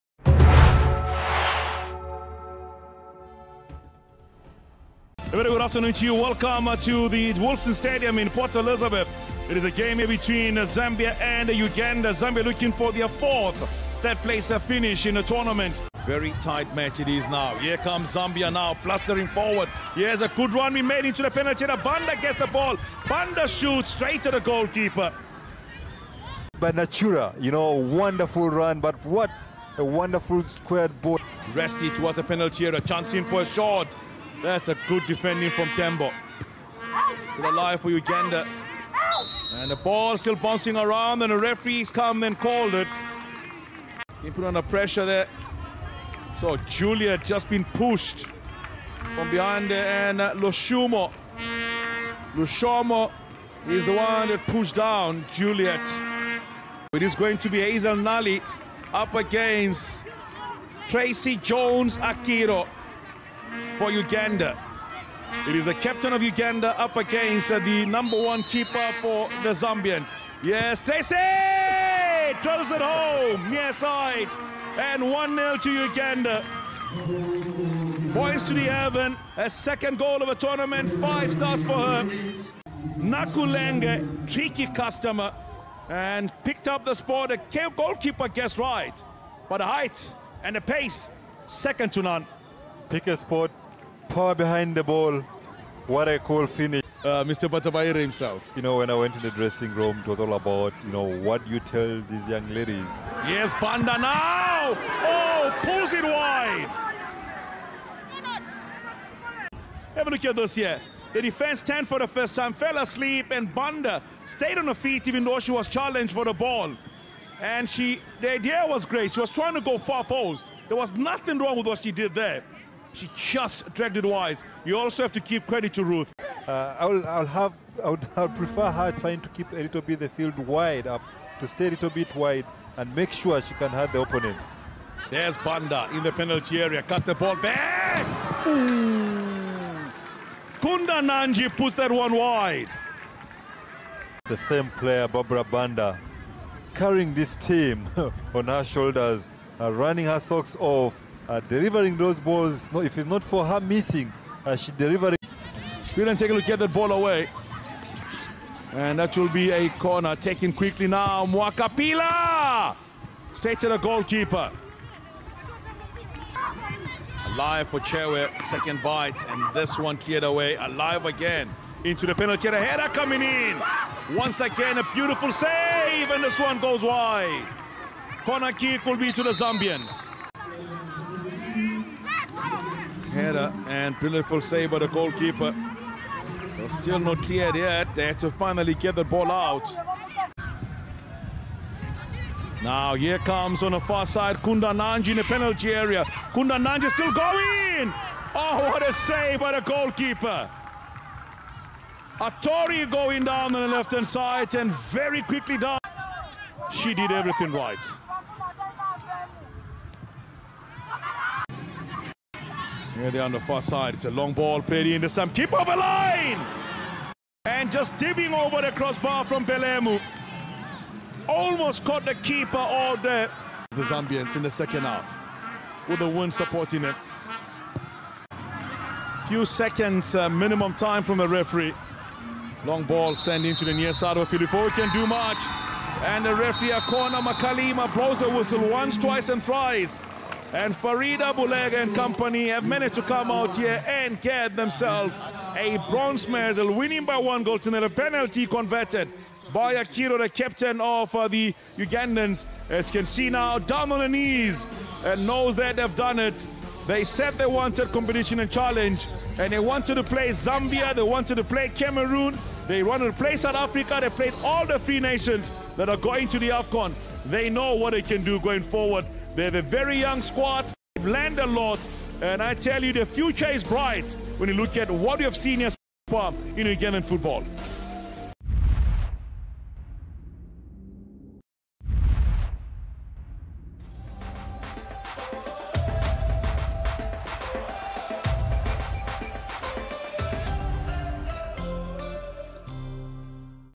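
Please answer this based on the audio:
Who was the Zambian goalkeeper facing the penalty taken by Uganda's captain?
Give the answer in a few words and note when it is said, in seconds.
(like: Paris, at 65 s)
Hazel Nali, at 57 s.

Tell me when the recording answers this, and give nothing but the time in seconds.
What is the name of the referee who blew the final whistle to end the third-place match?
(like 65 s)
236 s.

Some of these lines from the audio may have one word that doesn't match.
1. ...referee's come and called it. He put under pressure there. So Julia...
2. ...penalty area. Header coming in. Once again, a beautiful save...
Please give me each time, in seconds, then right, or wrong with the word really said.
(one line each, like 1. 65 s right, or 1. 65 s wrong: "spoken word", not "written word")
1. 41 s right
2. 172 s right.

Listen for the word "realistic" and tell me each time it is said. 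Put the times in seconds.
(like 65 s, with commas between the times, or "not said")
not said.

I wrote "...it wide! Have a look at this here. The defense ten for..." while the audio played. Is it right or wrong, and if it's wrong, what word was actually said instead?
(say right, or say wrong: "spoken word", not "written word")
right.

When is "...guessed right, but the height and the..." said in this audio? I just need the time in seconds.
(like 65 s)
88 s.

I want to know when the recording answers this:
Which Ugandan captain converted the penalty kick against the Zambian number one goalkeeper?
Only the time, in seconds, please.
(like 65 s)
60 s.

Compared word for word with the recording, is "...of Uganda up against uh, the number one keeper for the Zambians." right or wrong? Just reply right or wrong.
right.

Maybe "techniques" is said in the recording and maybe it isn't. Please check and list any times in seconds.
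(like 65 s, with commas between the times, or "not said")
not said.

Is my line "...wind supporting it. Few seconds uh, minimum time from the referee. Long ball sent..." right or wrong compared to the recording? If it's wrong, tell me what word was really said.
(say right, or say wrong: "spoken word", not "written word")
right.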